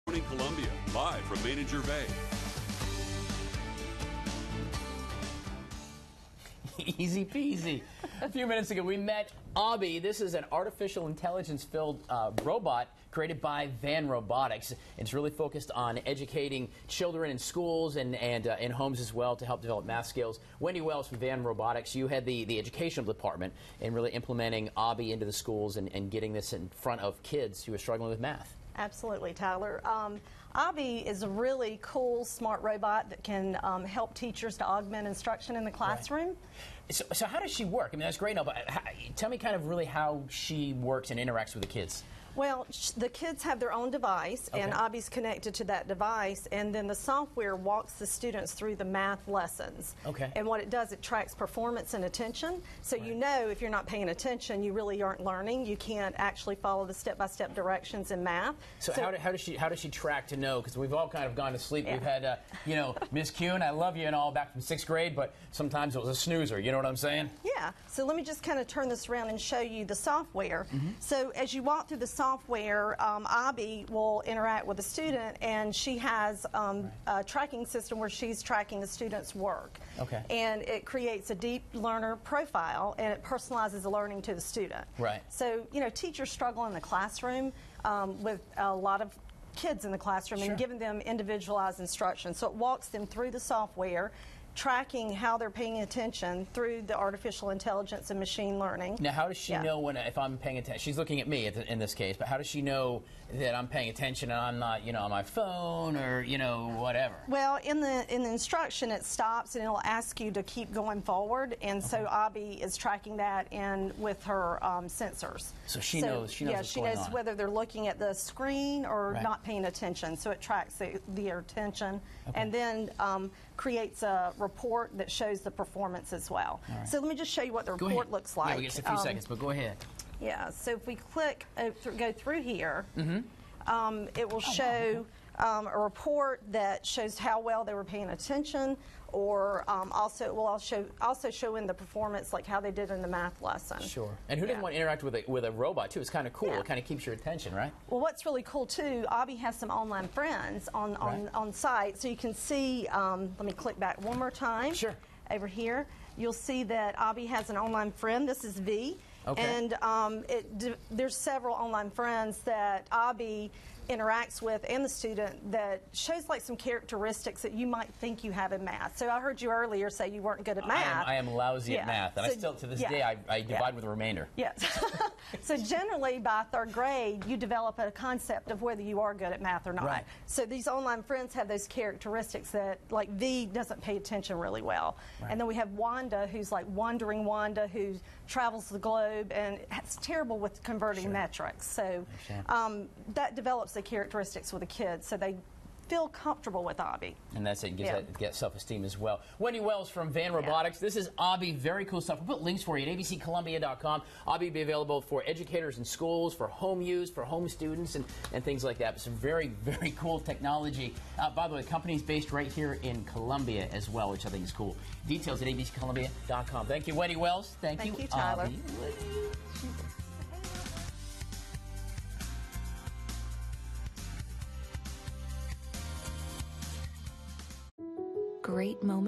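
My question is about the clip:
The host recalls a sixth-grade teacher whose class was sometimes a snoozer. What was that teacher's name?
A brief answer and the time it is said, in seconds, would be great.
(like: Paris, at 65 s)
Miss Kuhn, at 63 s.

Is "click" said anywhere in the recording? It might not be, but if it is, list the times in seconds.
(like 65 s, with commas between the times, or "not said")
130 s, 153 s.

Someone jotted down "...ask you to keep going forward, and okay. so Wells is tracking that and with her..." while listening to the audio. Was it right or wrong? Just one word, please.
wrong.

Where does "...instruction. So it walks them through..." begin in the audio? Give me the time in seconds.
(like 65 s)
91 s.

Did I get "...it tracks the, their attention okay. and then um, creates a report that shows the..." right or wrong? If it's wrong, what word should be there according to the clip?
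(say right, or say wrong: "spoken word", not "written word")
right.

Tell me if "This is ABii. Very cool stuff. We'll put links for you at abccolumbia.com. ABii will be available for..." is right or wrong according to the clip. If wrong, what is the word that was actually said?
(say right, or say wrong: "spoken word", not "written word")
right.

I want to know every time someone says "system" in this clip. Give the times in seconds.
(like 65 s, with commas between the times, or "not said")
77 s.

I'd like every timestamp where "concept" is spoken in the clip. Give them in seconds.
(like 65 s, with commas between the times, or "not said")
177 s.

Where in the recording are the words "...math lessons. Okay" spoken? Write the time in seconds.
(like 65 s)
48 s.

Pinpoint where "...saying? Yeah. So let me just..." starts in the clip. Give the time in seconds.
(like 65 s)
66 s.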